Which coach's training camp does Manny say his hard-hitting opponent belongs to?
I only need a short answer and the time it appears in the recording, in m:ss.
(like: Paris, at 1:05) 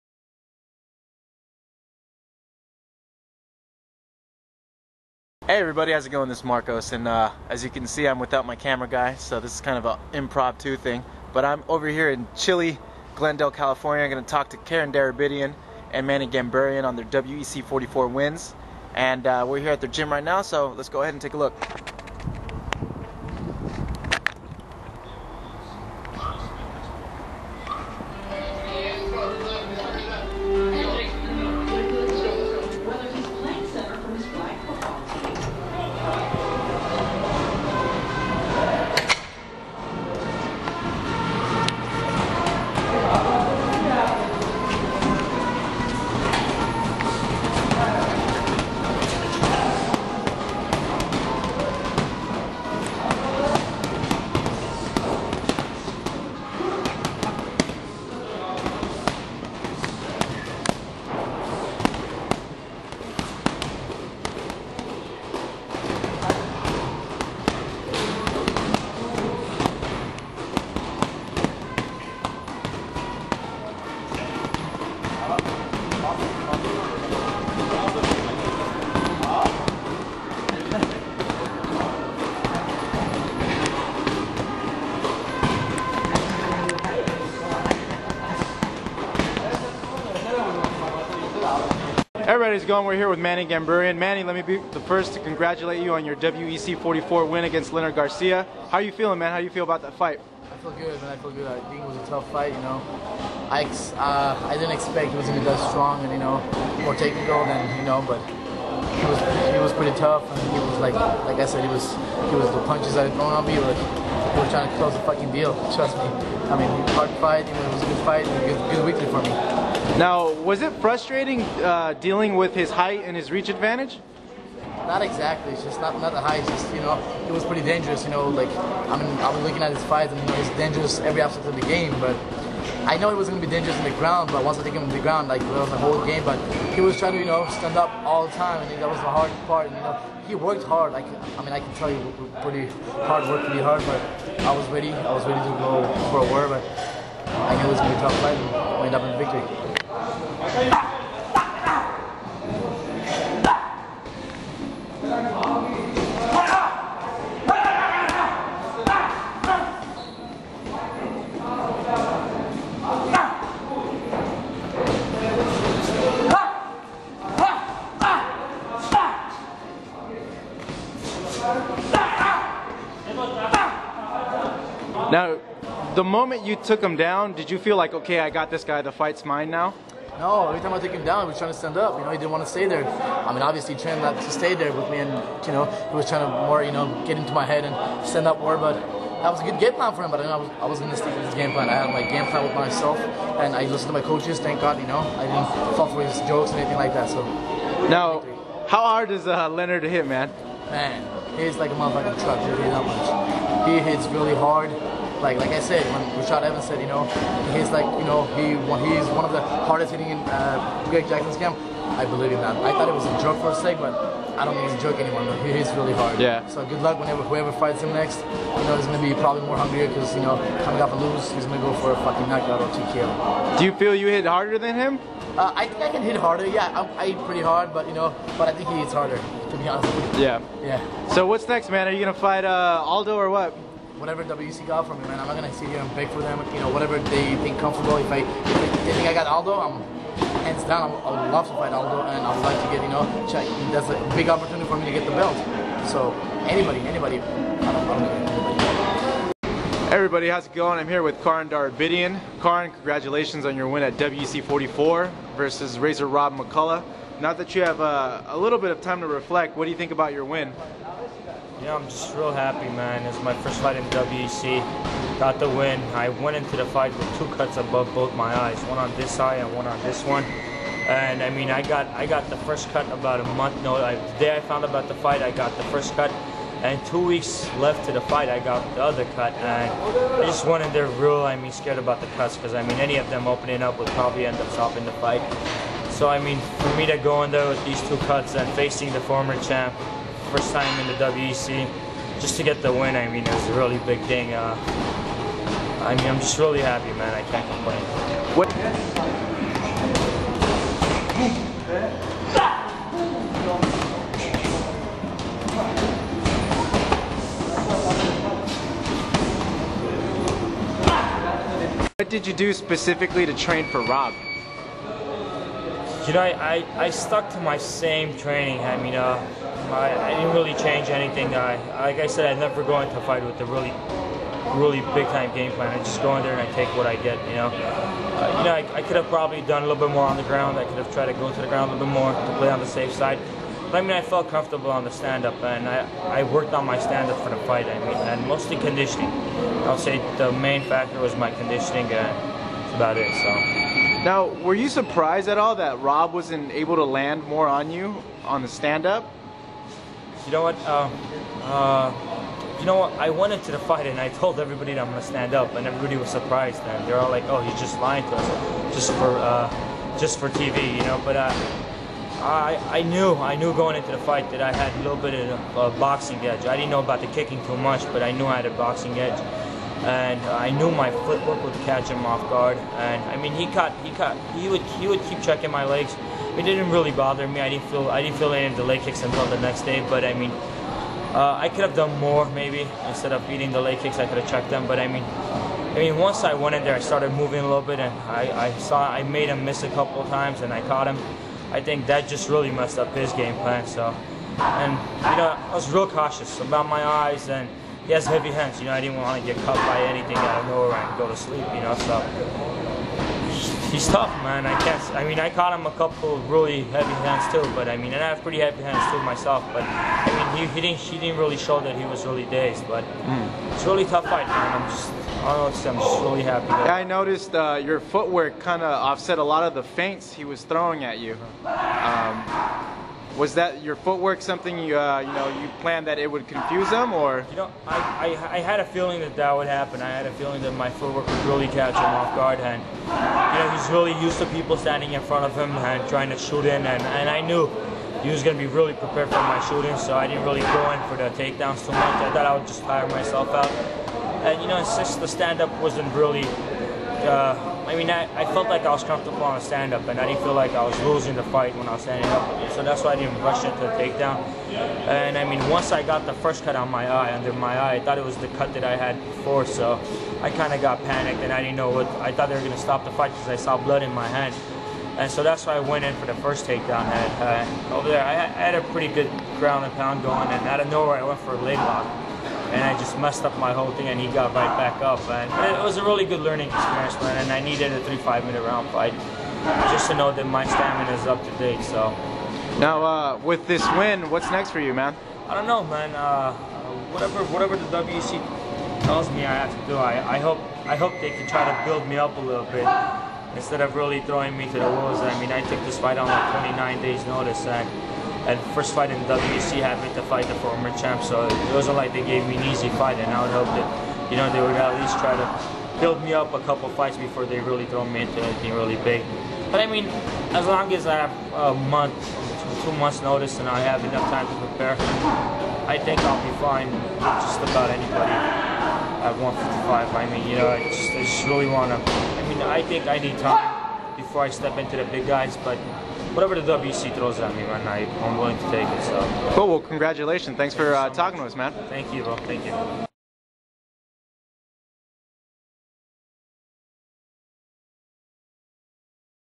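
Greg Jackson's, at 3:30.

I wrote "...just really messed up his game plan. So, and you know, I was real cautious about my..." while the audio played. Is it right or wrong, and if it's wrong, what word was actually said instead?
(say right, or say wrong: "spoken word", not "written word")
right.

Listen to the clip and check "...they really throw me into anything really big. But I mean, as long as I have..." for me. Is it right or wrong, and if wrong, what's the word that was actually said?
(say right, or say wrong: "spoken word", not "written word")
right.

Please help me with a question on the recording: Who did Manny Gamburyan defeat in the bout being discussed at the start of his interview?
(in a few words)
Leonard Garcia.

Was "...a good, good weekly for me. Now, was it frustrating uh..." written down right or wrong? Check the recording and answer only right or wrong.
right.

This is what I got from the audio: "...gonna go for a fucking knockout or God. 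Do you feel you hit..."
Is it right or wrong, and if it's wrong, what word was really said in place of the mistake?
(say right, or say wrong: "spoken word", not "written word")
wrong: "TKO", not "God".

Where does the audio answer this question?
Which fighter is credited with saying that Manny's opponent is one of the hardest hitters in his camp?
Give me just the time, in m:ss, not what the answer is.
3:26.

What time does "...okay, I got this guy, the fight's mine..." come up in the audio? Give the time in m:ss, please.
2:57.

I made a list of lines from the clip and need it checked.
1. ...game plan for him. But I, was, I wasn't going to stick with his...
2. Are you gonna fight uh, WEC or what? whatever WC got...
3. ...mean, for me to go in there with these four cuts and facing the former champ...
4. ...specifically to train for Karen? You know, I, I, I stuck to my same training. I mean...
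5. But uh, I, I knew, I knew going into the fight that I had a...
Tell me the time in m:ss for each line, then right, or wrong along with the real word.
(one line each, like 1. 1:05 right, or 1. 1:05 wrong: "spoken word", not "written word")
1. 3:09 right
2. 3:51 wrong: "Aldo", not "WEC"
3. 4:46 wrong: "two", not "four"
4. 5:12 wrong: "Rob", not "Karen"
5. 6:01 right.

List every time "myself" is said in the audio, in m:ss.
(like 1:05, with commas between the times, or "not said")
3:12, 6:49, 7:22.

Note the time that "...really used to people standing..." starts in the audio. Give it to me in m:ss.
7:13.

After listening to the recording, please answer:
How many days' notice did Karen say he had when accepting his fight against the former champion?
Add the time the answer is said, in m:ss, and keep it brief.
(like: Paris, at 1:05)
29, at 8:16.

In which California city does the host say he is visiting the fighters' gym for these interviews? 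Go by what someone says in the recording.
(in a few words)
Glendale.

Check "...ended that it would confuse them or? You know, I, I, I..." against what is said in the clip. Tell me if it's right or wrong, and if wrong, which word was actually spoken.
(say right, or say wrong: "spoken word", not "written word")
wrong: "planned", not "ended".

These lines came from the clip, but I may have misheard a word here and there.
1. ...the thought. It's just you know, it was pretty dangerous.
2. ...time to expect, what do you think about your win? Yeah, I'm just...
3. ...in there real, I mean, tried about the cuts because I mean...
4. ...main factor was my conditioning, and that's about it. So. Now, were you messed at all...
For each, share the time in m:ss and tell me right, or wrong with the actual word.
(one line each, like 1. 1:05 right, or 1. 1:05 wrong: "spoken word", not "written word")
1. 2:06 wrong: "height", not "thought"
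2. 4:18 wrong: "reflect", not "expect"
3. 4:40 wrong: "scared", not "tried"
4. 5:40 wrong: "surprised", not "messed".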